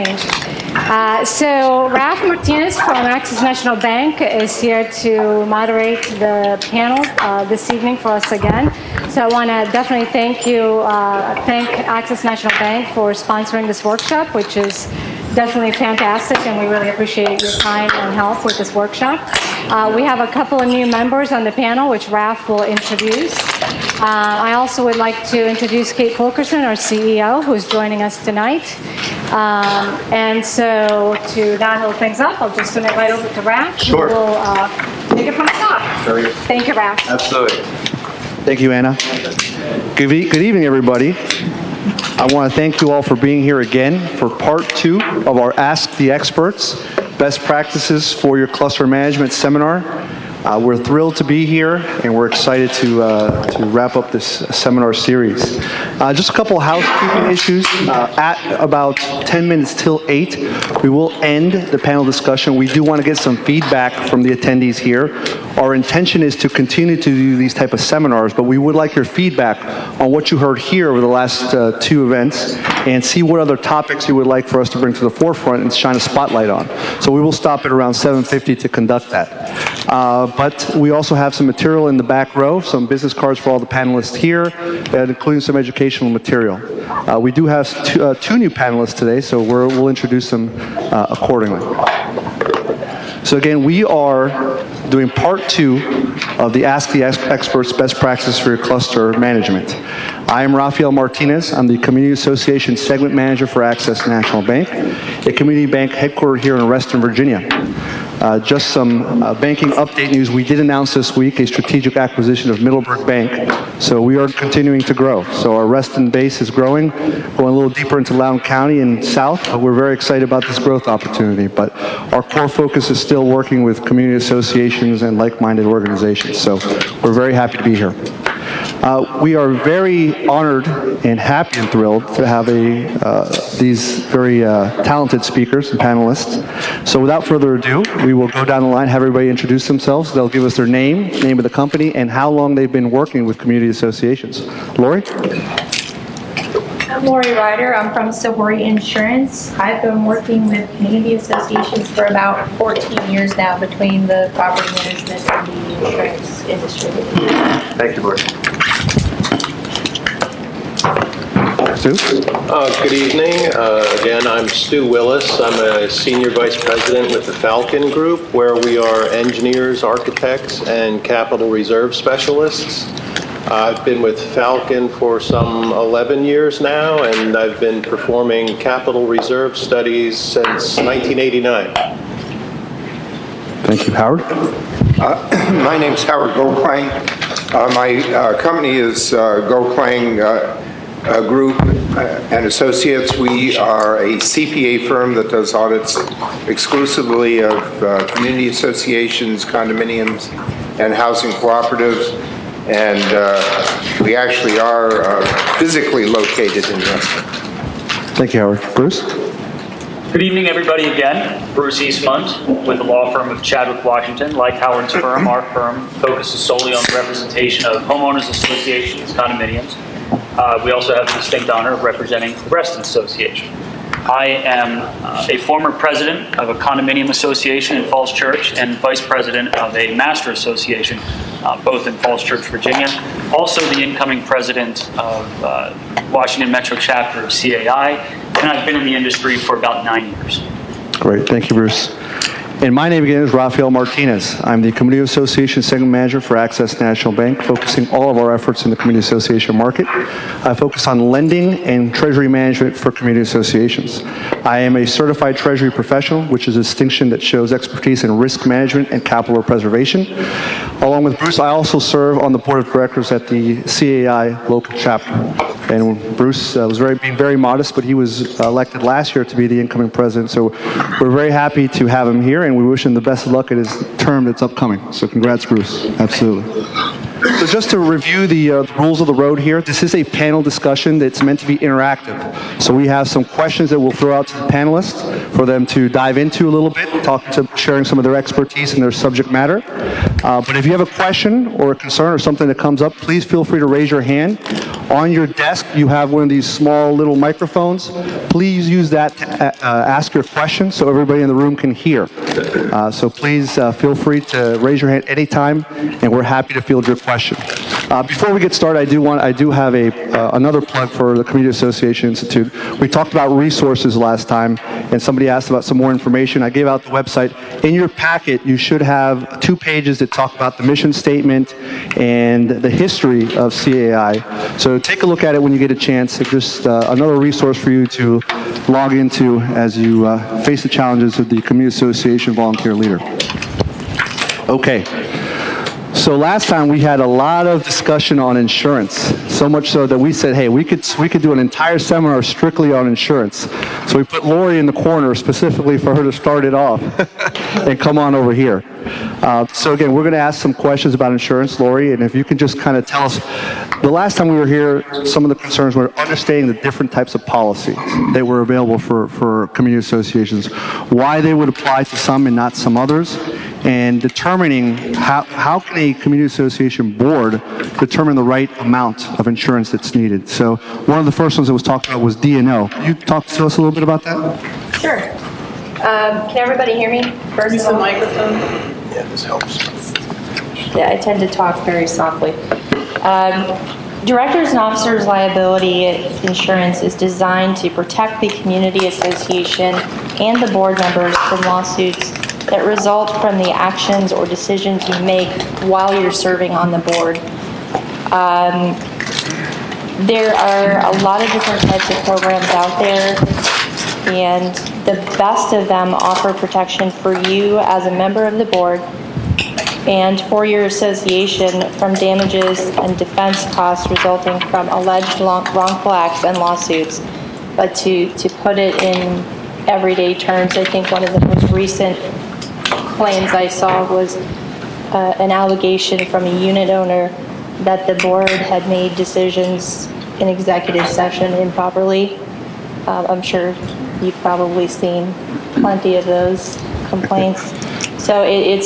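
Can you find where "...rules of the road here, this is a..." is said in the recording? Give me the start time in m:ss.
4:38.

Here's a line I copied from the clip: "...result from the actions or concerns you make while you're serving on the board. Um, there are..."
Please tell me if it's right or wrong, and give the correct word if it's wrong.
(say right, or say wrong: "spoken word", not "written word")
wrong: "decisions", not "concerns".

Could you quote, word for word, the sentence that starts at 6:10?
So one of the first ones that was talked about was D&O.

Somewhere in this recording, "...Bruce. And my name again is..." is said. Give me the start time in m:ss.
4:01.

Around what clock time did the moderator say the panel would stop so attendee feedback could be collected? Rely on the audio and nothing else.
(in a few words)
7:50.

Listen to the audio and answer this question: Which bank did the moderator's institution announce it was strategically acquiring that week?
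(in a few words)
Middleburg Bank.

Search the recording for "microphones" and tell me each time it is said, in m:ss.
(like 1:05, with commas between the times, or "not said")
4:57, 6:17.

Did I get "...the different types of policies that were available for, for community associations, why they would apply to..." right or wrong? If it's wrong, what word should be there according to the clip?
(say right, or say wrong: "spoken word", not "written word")
right.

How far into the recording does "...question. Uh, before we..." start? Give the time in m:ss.
5:07.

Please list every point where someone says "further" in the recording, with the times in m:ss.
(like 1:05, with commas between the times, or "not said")
2:17.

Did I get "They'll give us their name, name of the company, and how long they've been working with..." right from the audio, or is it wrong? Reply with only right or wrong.
right.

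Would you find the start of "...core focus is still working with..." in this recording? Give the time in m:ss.
2:02.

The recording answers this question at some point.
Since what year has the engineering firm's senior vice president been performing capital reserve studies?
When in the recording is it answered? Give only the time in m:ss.
3:00.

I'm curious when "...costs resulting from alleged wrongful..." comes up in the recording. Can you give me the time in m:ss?
6:53.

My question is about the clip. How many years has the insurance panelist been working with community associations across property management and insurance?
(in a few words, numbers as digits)
14.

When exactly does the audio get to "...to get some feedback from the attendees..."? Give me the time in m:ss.
1:03.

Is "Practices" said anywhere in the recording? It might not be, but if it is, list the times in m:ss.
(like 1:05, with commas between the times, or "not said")
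0:47, 1:37.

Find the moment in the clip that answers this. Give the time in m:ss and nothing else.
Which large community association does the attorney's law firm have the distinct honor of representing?
3:42.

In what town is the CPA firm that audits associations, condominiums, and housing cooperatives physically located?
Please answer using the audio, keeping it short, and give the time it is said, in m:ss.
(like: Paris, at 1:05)
Weston, at 3:26.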